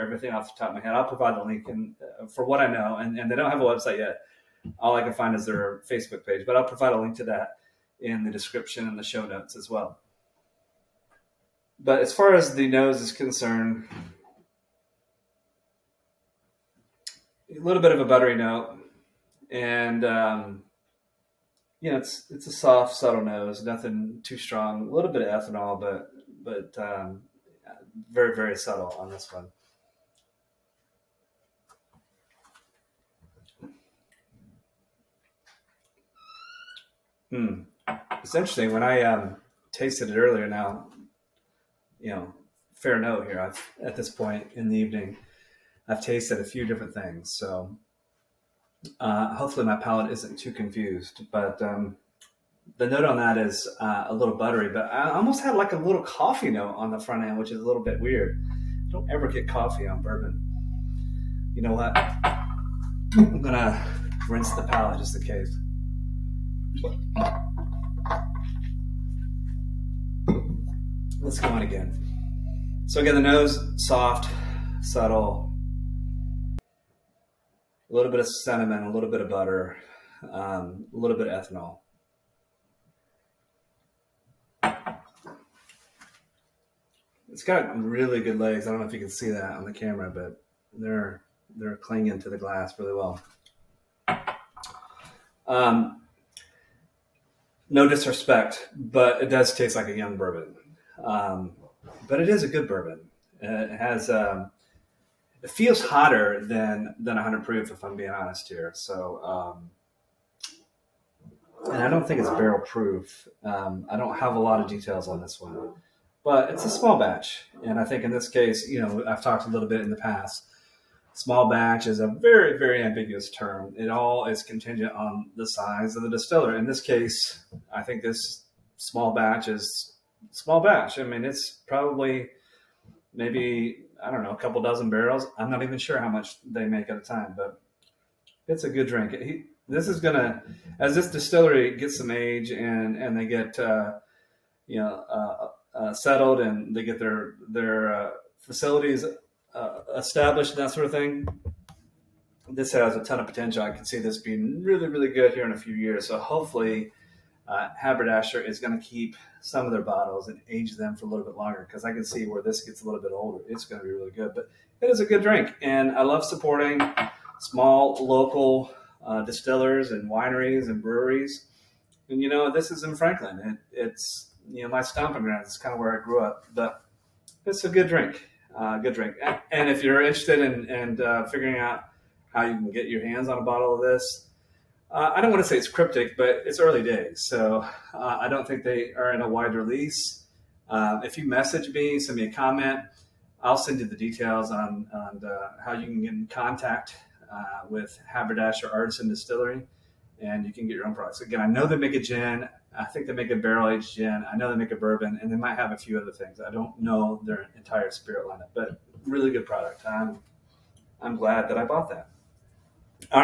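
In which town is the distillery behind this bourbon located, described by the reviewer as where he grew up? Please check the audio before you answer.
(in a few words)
Franklin.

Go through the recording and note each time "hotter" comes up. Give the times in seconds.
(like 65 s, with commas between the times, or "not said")
105 s.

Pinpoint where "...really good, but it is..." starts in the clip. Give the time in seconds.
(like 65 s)
163 s.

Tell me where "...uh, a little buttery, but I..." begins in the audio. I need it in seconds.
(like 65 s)
53 s.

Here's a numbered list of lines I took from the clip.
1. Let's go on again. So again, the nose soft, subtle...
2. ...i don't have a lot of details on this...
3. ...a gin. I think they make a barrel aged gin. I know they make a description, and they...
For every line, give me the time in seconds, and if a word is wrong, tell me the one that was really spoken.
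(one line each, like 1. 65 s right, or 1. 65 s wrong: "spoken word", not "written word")
1. 71 s right
2. 113 s right
3. 201 s wrong: "bourbon", not "description".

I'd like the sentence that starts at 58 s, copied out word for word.
I don't ever get coffee on bourbon.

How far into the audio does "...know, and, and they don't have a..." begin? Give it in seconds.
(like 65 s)
2 s.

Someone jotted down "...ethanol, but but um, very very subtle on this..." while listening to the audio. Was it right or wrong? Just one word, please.
right.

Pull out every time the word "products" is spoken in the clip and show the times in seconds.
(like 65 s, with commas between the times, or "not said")
200 s, 209 s.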